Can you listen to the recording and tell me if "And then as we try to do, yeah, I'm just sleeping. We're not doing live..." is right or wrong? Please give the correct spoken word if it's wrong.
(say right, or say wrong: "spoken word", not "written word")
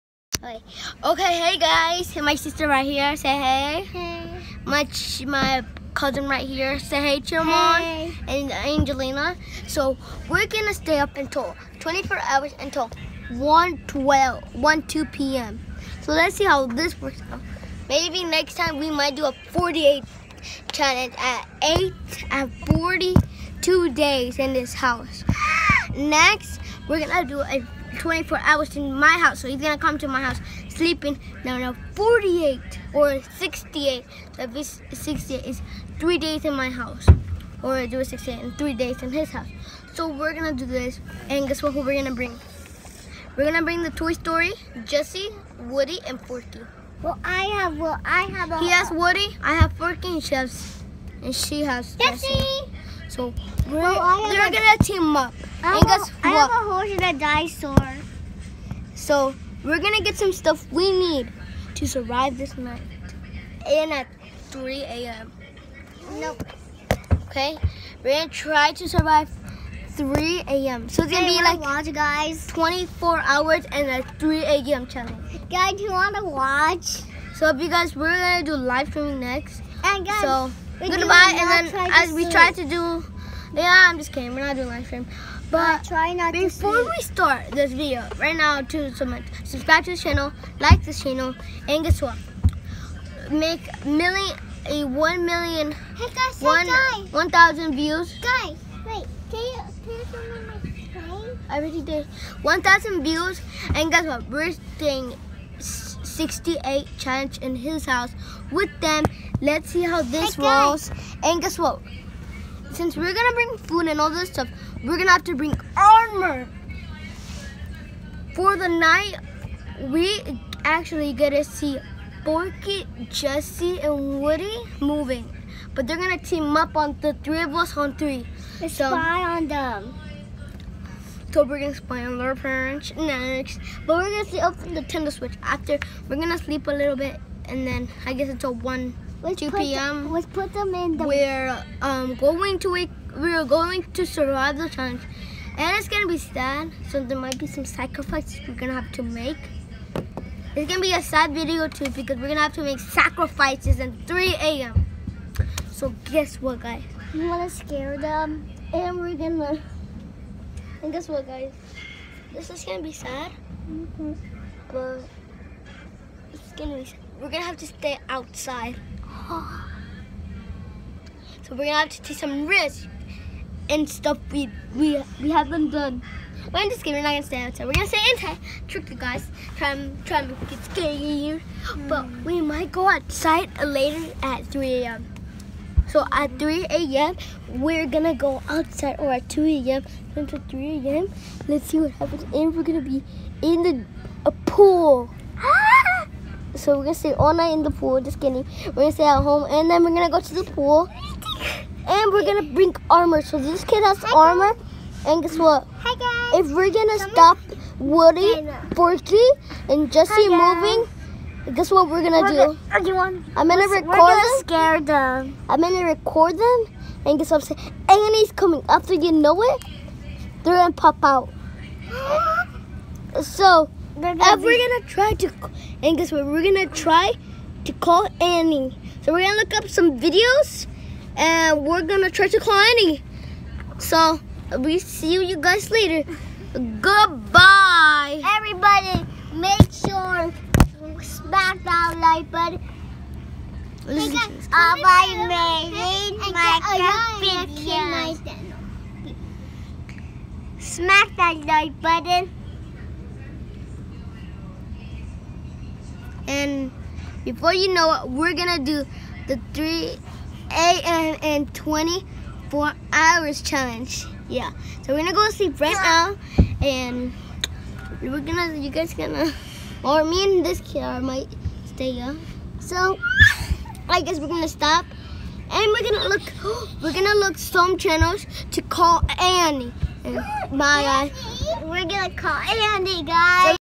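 wrong: "kidding", not "sleeping".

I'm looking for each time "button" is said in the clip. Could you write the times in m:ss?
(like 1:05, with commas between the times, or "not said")
4:02, 4:11.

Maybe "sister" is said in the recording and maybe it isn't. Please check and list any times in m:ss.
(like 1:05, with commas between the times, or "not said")
0:02.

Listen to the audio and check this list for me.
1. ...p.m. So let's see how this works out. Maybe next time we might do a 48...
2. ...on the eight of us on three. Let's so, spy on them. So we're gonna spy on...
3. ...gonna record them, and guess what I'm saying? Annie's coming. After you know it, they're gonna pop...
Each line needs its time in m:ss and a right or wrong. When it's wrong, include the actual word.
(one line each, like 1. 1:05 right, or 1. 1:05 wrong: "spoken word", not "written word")
1. 0:15 right
2. 2:06 wrong: "three", not "eight"
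3. 3:35 right.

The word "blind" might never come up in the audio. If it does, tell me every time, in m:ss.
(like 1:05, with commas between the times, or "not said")
not said.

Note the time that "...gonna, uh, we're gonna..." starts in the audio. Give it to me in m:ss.
3:44.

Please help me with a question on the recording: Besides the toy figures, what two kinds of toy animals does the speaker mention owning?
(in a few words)
a horse and a dinosaur.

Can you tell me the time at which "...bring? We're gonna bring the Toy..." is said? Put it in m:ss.
0:42.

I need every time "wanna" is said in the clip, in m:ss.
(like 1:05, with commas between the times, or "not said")
1:15, 2:37.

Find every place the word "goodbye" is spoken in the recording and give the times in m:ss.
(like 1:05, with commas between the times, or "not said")
1:20, 3:56.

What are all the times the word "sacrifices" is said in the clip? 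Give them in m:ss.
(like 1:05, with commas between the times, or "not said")
2:27, 2:32.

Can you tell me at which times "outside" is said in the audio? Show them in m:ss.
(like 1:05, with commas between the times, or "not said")
2:48, 2:57, 3:02, 3:08.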